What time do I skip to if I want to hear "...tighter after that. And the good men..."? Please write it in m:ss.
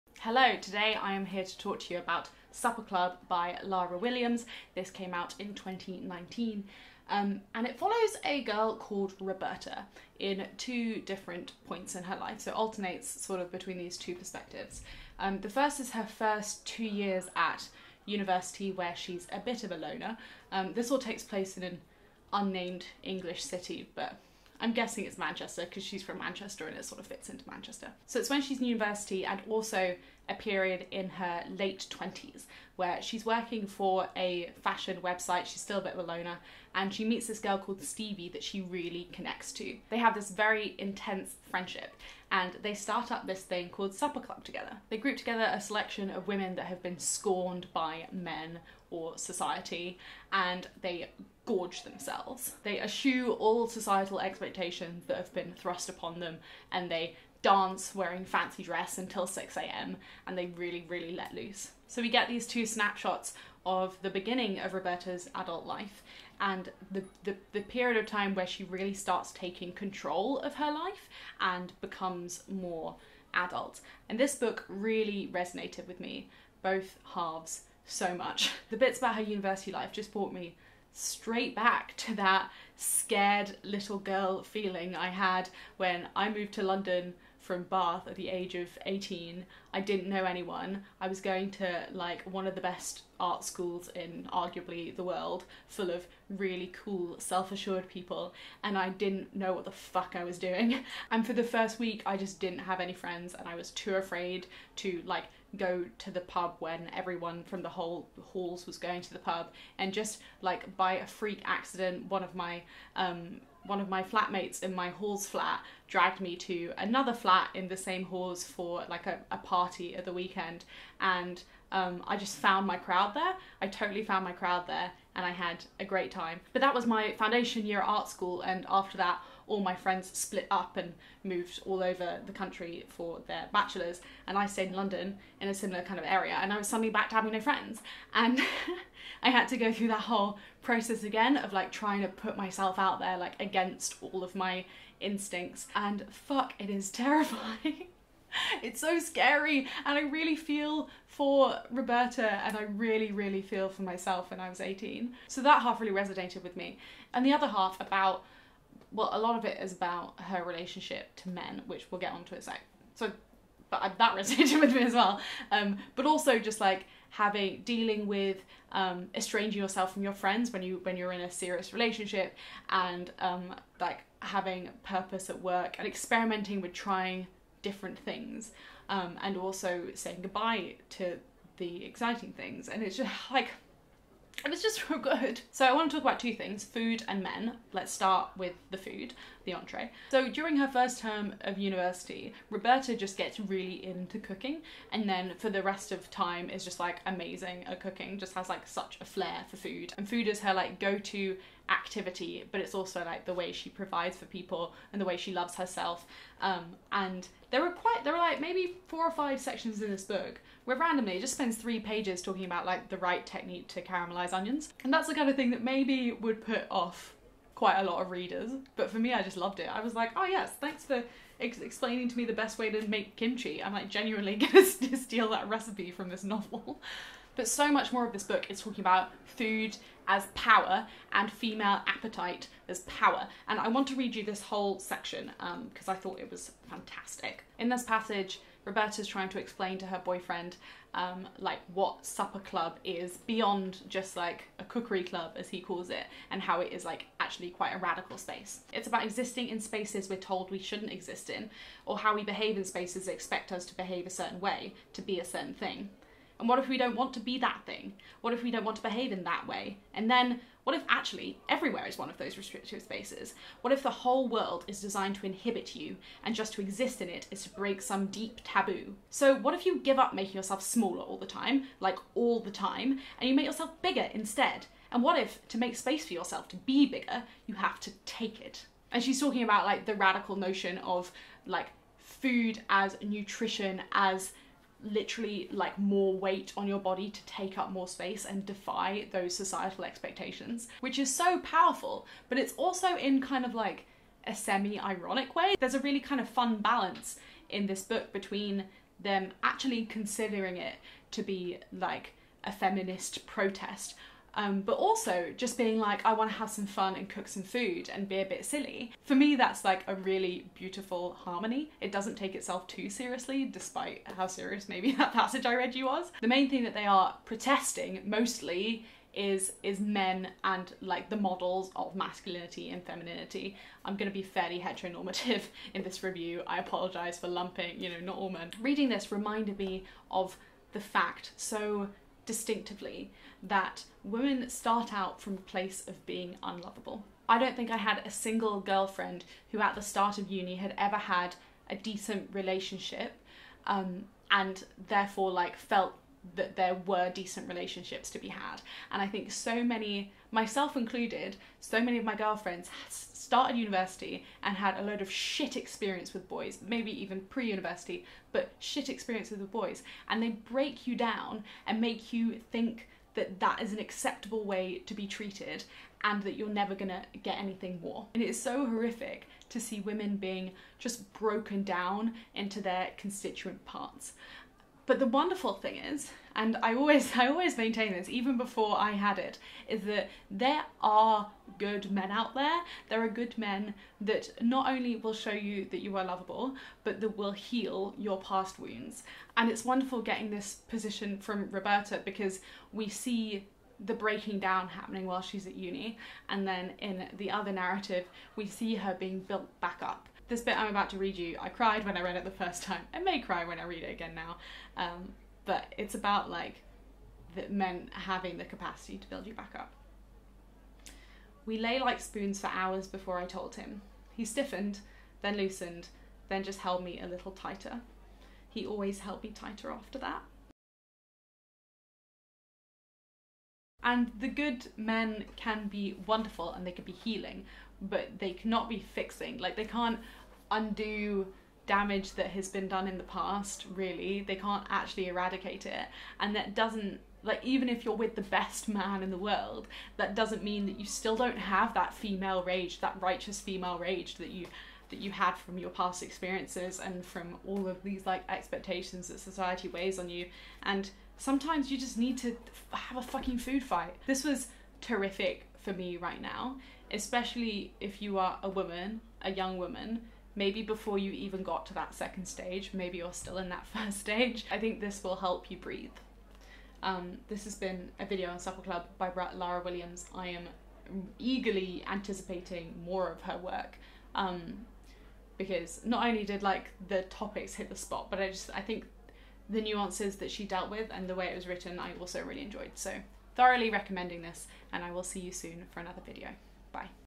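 6:59.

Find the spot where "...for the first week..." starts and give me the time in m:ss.
1:41.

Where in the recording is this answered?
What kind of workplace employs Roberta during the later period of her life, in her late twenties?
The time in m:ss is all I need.
0:34.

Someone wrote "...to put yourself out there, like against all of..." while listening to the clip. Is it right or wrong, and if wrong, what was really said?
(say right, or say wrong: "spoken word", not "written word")
wrong: "myself", not "yourself".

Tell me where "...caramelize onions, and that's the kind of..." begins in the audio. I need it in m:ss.
3:33.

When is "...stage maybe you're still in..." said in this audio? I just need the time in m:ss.
7:42.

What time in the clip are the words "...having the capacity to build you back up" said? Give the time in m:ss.
6:47.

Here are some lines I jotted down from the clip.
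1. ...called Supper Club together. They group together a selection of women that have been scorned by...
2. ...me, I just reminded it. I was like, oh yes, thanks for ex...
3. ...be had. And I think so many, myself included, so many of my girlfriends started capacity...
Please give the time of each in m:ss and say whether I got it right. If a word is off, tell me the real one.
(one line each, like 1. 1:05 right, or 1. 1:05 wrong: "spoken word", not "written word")
1. 0:43 right
2. 3:38 wrong: "loved", not "reminded"
3. 5:48 wrong: "university", not "capacity".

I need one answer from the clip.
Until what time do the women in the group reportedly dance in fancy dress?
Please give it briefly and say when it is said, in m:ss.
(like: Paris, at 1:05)
6 a.m., at 0:59.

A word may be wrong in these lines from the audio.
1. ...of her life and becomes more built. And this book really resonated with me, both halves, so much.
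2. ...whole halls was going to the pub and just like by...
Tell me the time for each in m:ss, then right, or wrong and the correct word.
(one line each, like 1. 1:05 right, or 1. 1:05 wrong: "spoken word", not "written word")
1. 1:10 wrong: "adult", not "built"
2. 1:47 right.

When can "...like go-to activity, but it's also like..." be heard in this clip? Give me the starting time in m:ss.
3:20.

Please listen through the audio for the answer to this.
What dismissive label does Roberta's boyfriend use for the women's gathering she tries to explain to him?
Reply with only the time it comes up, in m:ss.
4:04.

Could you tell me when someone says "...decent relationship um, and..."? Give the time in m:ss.
5:41.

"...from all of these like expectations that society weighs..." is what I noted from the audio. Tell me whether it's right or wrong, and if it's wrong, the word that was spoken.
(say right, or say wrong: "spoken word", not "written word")
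right.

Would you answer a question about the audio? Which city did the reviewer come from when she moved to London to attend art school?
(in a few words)
Bath.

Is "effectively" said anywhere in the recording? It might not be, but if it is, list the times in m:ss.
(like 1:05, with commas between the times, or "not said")
not said.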